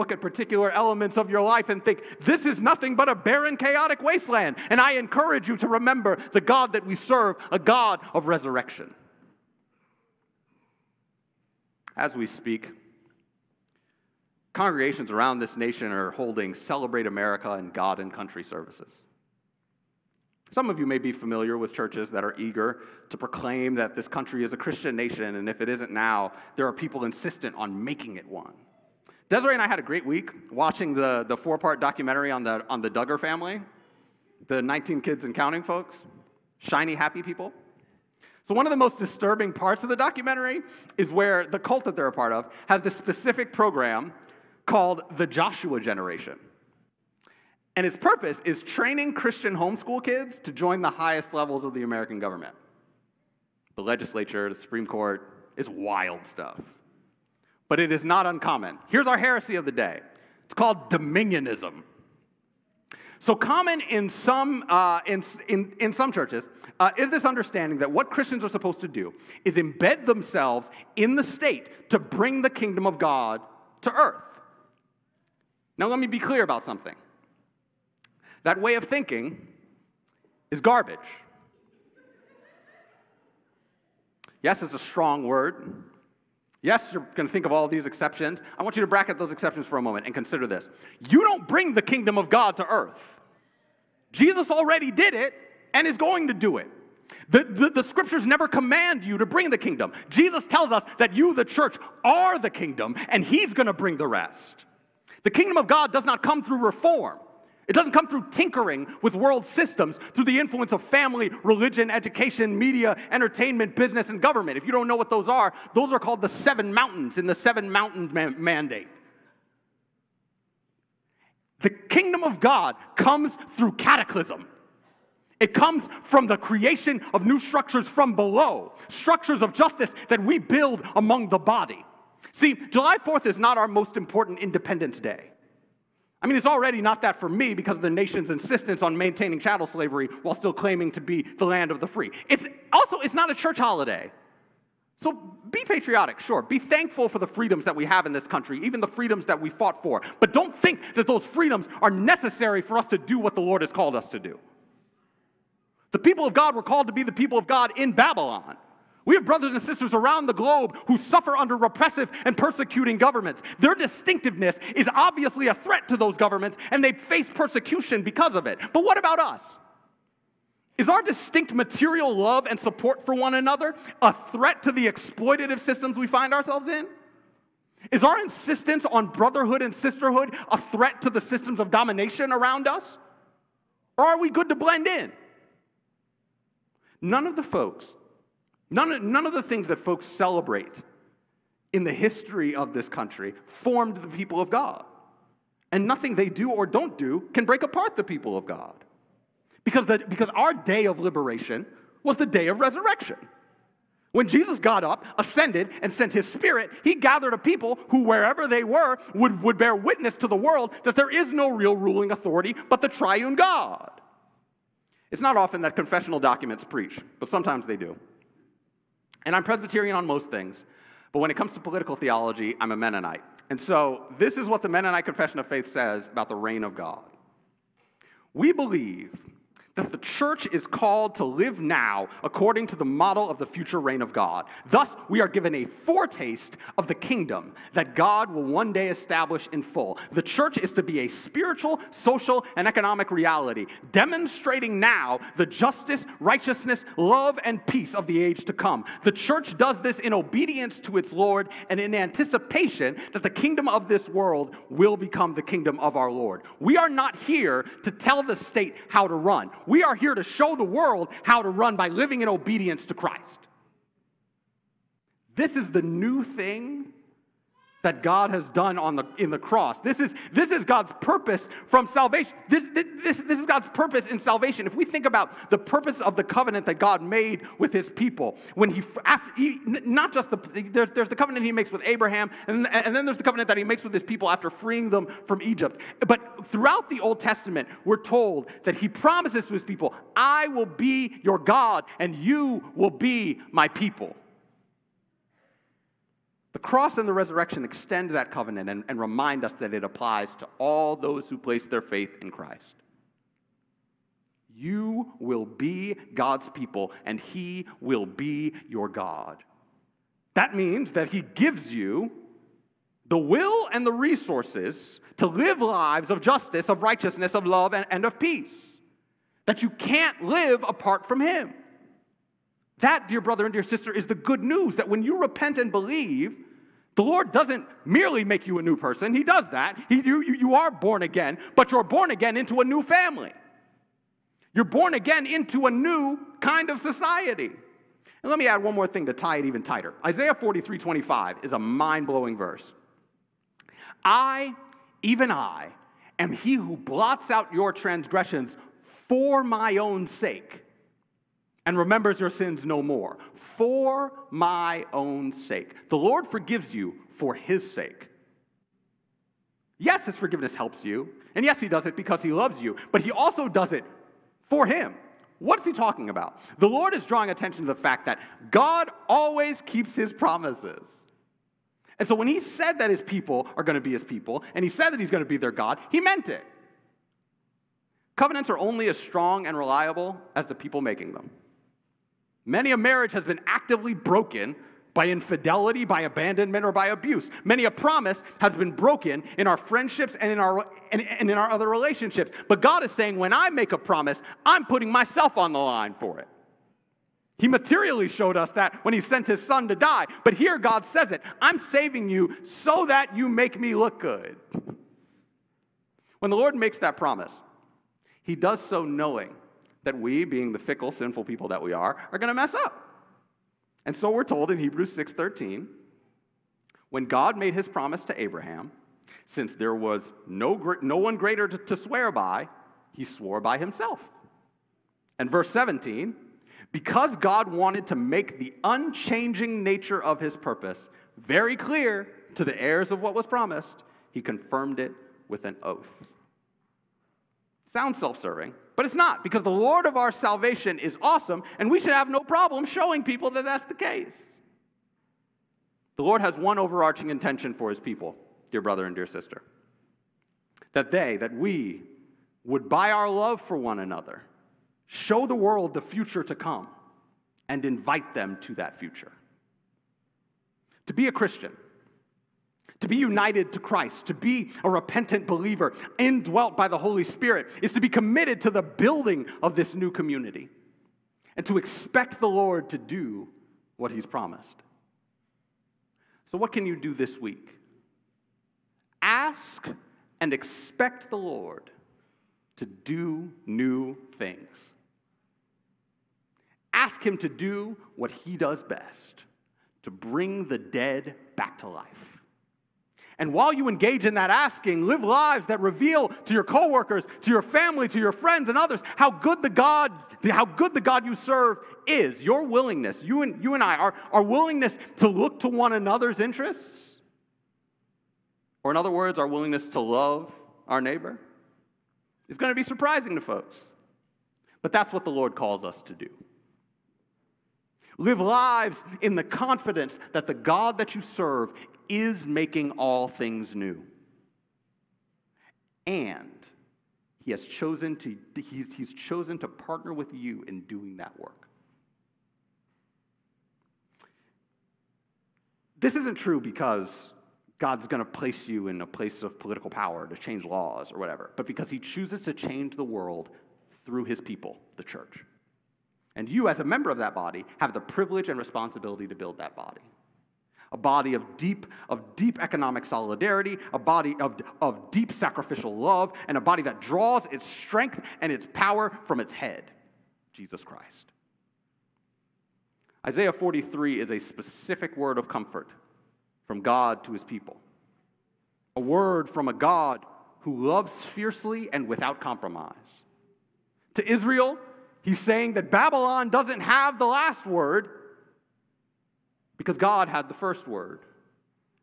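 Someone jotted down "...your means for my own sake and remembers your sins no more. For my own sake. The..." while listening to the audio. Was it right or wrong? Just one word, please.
wrong.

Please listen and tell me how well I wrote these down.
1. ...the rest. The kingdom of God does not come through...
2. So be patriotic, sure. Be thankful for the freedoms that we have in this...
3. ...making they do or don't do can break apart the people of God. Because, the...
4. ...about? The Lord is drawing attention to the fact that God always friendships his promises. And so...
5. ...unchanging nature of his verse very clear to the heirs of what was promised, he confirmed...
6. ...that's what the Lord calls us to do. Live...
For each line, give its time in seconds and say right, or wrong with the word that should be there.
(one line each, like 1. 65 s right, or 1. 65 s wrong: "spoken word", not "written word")
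1. 103 s right
2. 144 s right
3. 195 s wrong: "nothing", not "making"
4. 366 s wrong: "keeps", not "friendships"
5. 428 s wrong: "purpose", not "verse"
6. 514 s right.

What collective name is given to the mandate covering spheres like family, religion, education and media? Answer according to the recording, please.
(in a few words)
seven mountain mandate.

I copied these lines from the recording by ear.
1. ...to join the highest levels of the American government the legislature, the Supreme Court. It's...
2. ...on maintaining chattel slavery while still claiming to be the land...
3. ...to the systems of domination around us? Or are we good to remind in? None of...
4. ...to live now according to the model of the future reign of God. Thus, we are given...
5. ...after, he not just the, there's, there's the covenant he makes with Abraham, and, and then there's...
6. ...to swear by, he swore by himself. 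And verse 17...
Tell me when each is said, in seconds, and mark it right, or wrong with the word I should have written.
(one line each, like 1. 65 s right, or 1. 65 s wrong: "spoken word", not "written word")
1. 50 s right
2. 138 s right
3. 181 s wrong: "blend", not "remind"
4. 231 s right
5. 279 s right
6. 421 s right.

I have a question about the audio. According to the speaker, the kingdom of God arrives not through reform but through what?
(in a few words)
cataclysm.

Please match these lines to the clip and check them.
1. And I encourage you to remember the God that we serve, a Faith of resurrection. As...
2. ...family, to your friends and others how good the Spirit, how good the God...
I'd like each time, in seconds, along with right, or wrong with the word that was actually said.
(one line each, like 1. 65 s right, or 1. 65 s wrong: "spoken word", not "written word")
1. 4 s wrong: "God", not "Faith"
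2. 497 s wrong: "God", not "Spirit".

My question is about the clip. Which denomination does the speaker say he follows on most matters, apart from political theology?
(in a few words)
Presbyterian.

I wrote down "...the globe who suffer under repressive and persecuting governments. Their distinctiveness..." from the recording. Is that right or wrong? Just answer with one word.
right.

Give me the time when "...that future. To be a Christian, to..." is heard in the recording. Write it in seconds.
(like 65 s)
458 s.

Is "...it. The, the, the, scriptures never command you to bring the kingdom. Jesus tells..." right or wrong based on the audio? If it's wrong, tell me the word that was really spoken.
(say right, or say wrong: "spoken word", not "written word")
right.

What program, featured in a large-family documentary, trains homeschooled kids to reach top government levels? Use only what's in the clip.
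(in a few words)
Joshua Generation.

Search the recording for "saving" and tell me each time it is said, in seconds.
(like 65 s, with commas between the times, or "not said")
401 s.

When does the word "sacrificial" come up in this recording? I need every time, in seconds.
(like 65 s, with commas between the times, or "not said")
555 s.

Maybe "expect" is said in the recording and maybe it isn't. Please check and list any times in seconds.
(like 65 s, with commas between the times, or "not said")
471 s, 480 s.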